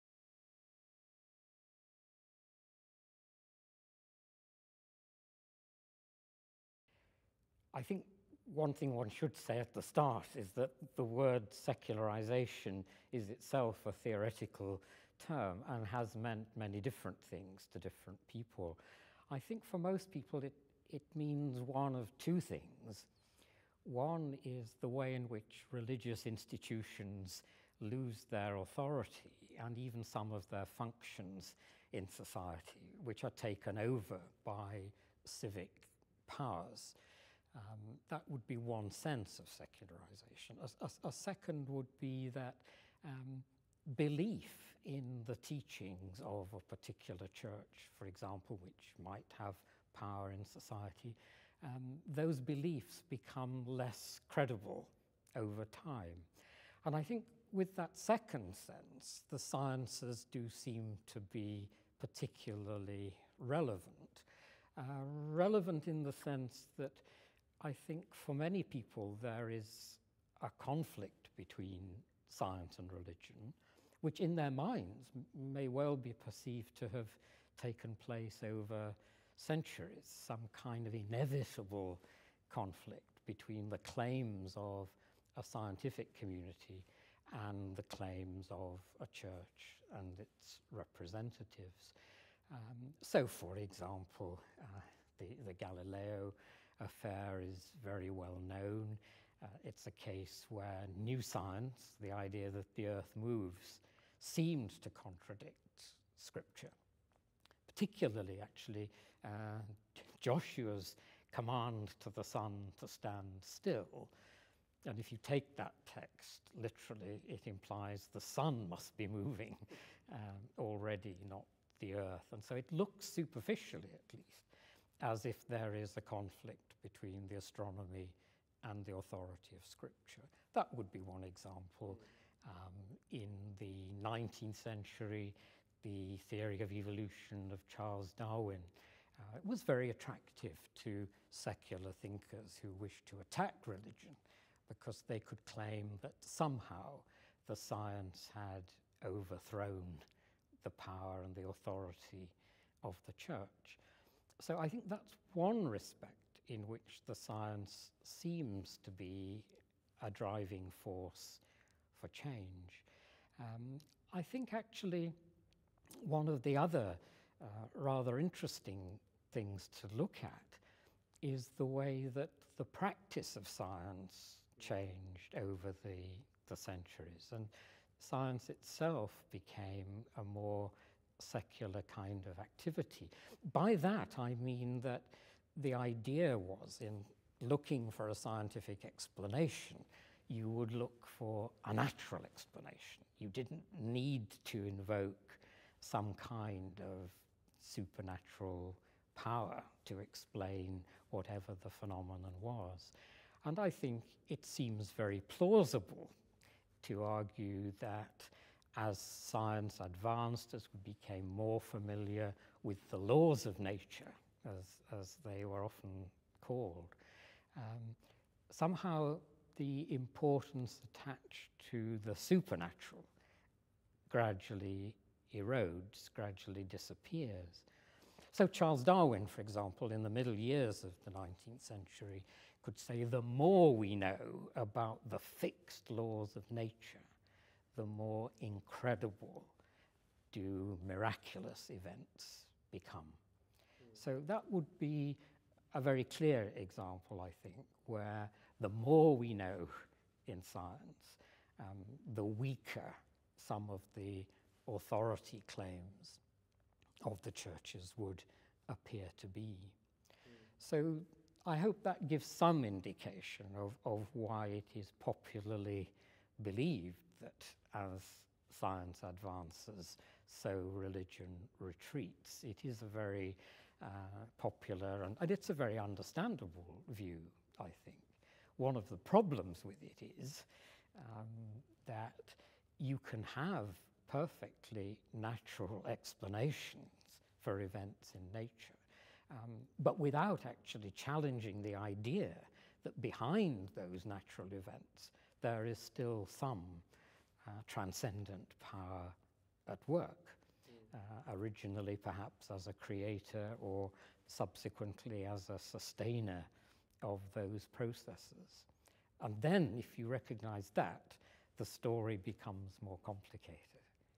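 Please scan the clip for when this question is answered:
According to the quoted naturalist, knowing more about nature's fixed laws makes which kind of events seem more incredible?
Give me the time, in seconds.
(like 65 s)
240 s.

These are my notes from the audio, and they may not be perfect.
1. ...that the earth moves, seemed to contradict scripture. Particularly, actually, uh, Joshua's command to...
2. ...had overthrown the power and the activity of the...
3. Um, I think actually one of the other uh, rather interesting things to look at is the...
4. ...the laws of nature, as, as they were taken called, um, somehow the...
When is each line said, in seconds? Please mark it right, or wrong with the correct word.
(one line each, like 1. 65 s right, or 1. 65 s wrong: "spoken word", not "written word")
1. 102 s right
2. 148 s wrong: "authority", not "activity"
3. 163 s right
4. 212 s wrong: "often", not "taken".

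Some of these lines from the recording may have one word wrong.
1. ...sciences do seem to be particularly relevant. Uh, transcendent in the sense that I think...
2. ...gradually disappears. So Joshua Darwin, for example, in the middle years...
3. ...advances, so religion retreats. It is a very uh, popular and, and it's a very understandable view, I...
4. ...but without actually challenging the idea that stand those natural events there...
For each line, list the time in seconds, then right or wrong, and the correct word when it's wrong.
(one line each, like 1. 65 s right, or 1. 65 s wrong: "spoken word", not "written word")
1. 59 s wrong: "relevant", not "transcendent"
2. 226 s wrong: "Charles", not "Joshua"
3. 269 s right
4. 289 s wrong: "behind", not "stand".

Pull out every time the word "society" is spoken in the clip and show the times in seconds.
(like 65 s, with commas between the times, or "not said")
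32 s, 50 s.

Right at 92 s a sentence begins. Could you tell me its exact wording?
Um, so, for example, uh, the, the Galileo affair is very well known.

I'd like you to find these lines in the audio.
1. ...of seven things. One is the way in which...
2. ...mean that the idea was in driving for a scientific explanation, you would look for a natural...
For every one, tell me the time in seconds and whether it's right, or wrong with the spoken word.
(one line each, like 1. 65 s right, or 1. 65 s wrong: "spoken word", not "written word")
1. 21 s wrong: "two", not "seven"
2. 184 s wrong: "looking", not "driving".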